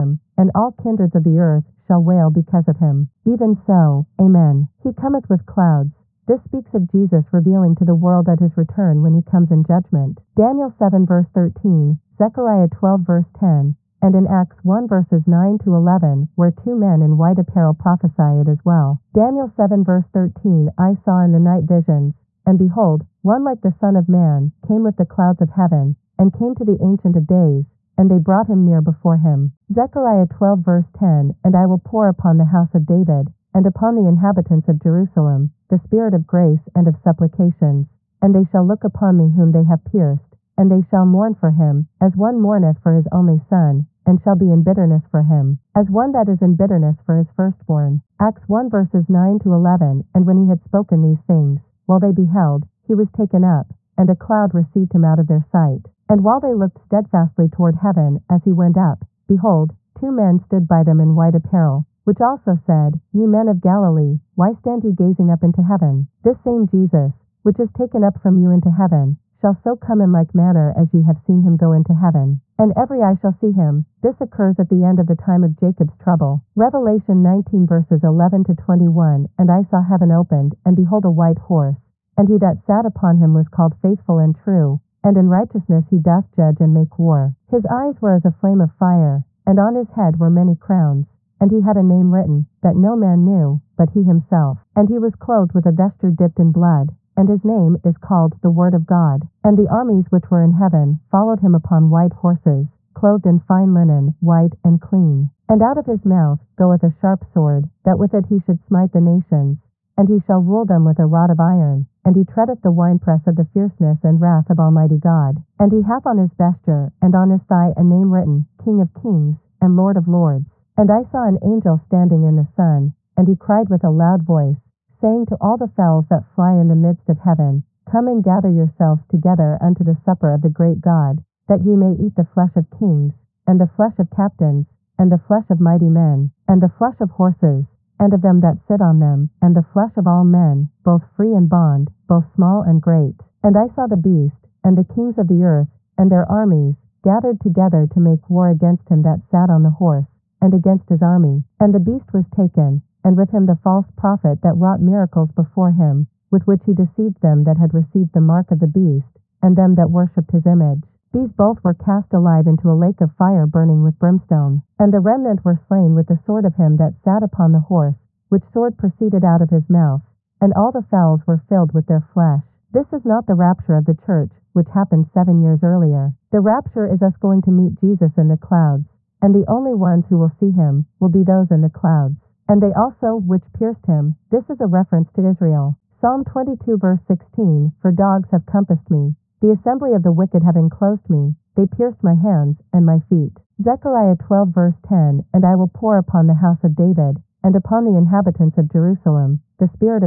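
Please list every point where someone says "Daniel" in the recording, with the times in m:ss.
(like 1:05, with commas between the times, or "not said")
0:10, 0:19.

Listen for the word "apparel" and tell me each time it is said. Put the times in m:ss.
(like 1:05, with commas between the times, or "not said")
0:17, 1:01.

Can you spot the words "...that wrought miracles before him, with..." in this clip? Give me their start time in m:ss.
2:34.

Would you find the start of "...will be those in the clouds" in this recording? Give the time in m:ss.
3:00.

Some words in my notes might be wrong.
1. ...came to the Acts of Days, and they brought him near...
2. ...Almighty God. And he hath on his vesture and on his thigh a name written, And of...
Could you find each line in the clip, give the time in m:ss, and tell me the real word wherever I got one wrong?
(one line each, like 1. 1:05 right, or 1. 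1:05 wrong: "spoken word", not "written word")
1. 0:26 wrong: "Ancient", not "Acts"
2. 1:54 wrong: "King", not "And".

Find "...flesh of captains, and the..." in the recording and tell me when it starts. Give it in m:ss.
2:13.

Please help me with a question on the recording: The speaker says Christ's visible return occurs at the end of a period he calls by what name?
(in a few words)
The time of Jacob's trouble.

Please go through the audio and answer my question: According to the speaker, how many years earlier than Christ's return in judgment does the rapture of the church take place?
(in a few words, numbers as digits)
7.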